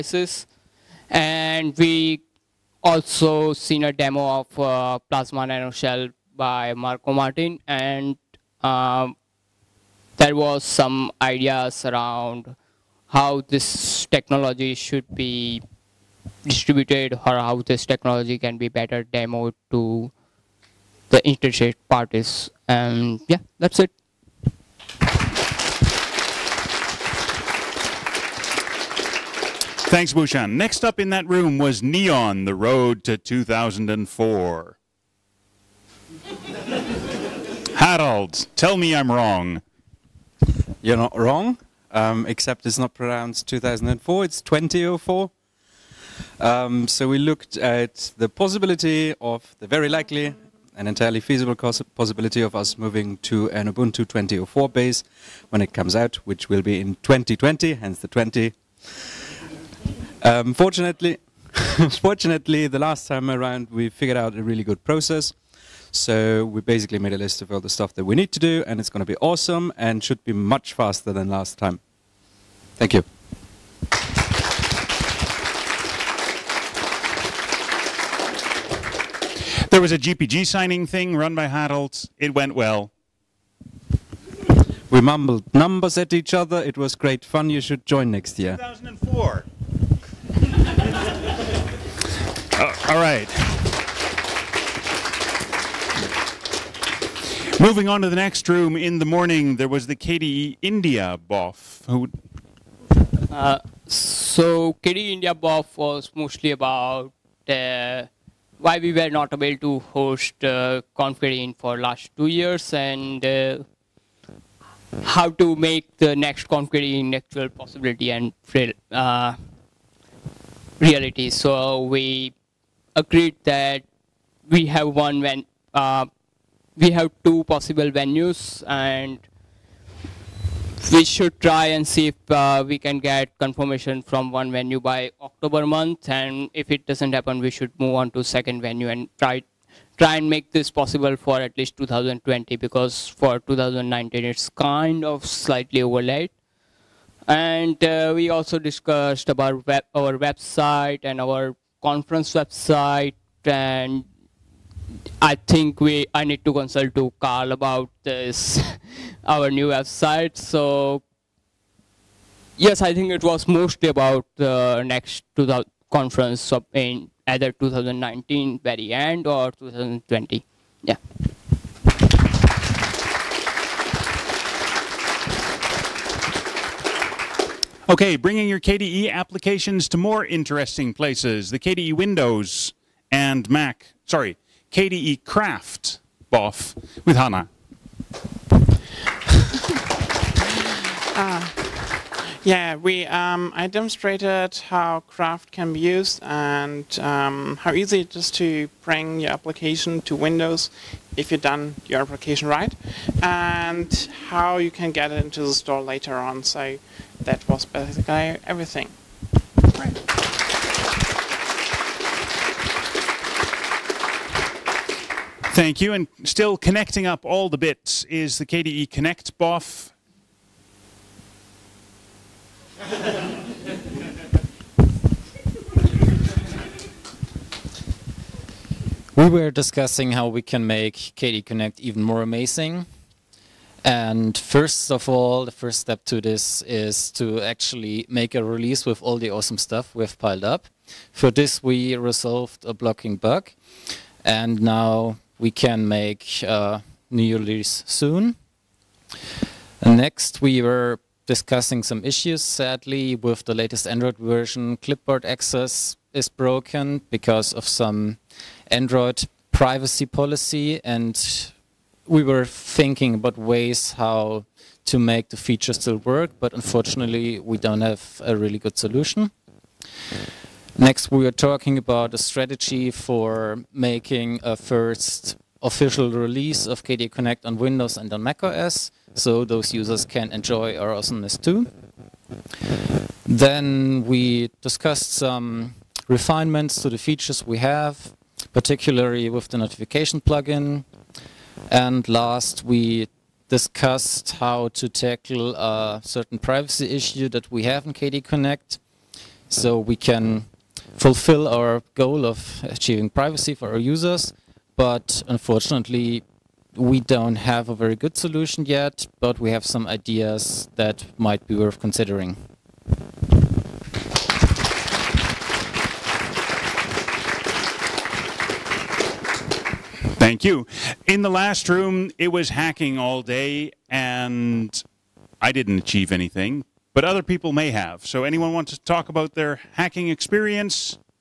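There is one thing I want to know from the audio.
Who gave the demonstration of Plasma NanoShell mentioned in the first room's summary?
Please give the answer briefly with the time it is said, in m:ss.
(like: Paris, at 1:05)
Marco Martin, at 0:06.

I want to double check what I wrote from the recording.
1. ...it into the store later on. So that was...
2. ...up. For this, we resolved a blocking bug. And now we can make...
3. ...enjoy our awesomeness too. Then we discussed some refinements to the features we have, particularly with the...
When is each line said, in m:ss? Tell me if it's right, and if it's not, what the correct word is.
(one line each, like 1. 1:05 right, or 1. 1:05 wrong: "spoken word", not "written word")
1. 3:25 right
2. 4:00 right
3. 4:40 right.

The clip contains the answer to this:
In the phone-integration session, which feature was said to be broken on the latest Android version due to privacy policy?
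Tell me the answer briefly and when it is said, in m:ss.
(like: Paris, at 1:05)
clipboard access, at 4:14.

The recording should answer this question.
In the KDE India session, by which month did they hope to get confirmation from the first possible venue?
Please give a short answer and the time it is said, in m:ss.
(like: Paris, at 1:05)
October, at 2:15.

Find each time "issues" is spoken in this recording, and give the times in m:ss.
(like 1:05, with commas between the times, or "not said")
4:12, 4:56.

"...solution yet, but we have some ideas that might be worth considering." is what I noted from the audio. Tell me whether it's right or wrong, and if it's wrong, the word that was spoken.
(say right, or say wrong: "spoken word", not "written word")
right.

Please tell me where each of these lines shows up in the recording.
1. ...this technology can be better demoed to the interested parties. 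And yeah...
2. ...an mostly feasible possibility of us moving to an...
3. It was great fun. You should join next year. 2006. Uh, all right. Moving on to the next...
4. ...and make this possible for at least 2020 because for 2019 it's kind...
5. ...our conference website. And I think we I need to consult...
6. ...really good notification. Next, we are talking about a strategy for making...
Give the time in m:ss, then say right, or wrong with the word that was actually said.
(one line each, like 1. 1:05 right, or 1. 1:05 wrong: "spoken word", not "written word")
1. 0:17 right
2. 0:50 wrong: "entirely", not "mostly"
3. 1:26 wrong: "2004", not "2006"
4. 2:20 right
5. 2:31 right
6. 4:28 wrong: "solution", not "notification".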